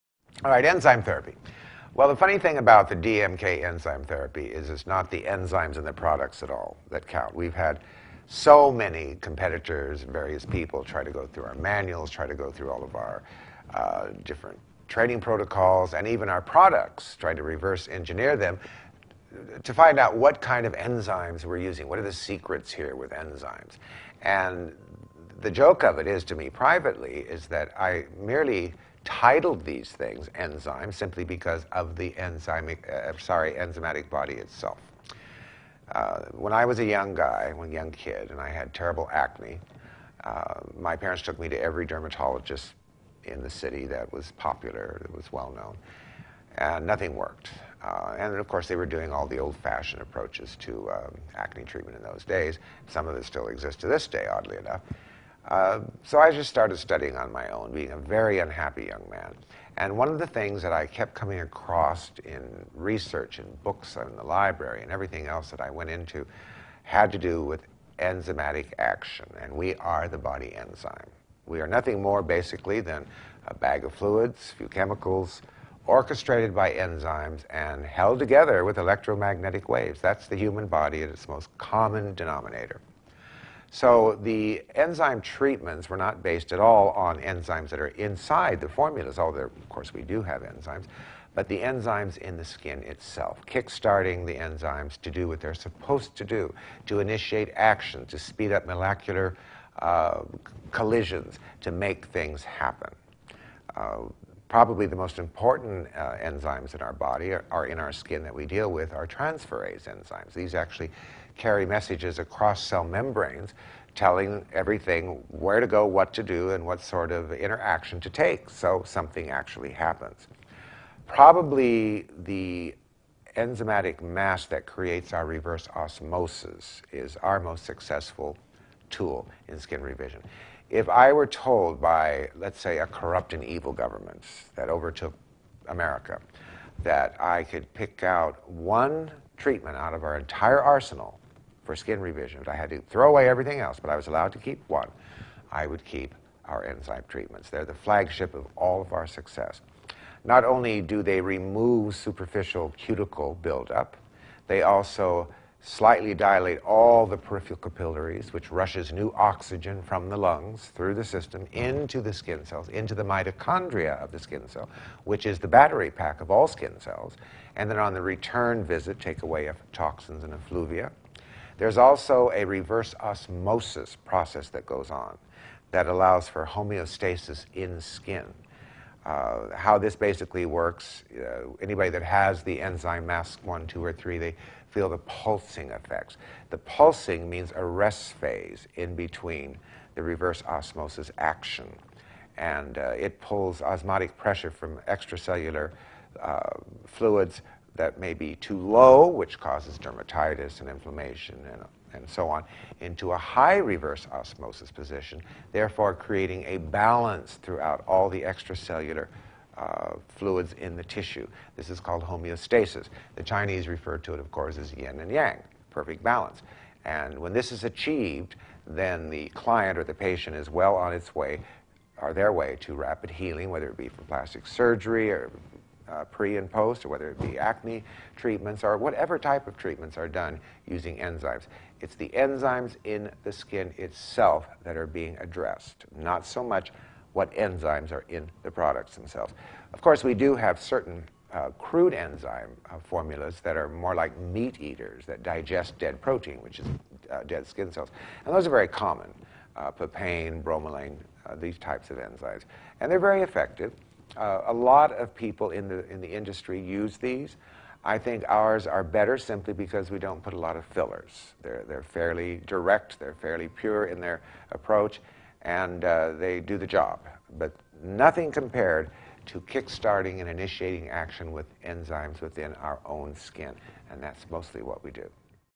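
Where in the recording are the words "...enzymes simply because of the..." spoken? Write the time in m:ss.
0:30.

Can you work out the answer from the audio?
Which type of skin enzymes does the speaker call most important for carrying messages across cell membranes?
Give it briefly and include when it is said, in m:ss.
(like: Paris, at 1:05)
Transferase enzymes, at 1:49.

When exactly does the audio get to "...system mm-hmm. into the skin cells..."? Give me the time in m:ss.
2:41.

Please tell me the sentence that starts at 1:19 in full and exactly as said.
That's the human body at its most common denominator.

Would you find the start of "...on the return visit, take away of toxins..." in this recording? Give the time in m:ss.
2:47.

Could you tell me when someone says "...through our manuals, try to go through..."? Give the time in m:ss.
0:11.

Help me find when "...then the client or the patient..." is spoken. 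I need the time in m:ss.
3:38.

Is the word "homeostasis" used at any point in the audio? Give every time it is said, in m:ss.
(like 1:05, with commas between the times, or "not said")
2:56, 3:32.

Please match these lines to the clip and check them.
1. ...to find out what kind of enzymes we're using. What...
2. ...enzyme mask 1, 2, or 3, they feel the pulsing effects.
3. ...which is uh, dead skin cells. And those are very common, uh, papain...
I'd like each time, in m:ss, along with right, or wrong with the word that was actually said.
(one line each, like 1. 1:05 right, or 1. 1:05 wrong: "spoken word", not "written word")
1. 0:19 right
2. 3:02 right
3. 4:06 right.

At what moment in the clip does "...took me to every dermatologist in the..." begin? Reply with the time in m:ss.
0:41.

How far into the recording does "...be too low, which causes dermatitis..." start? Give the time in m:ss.
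3:18.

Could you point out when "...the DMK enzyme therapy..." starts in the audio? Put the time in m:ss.
0:02.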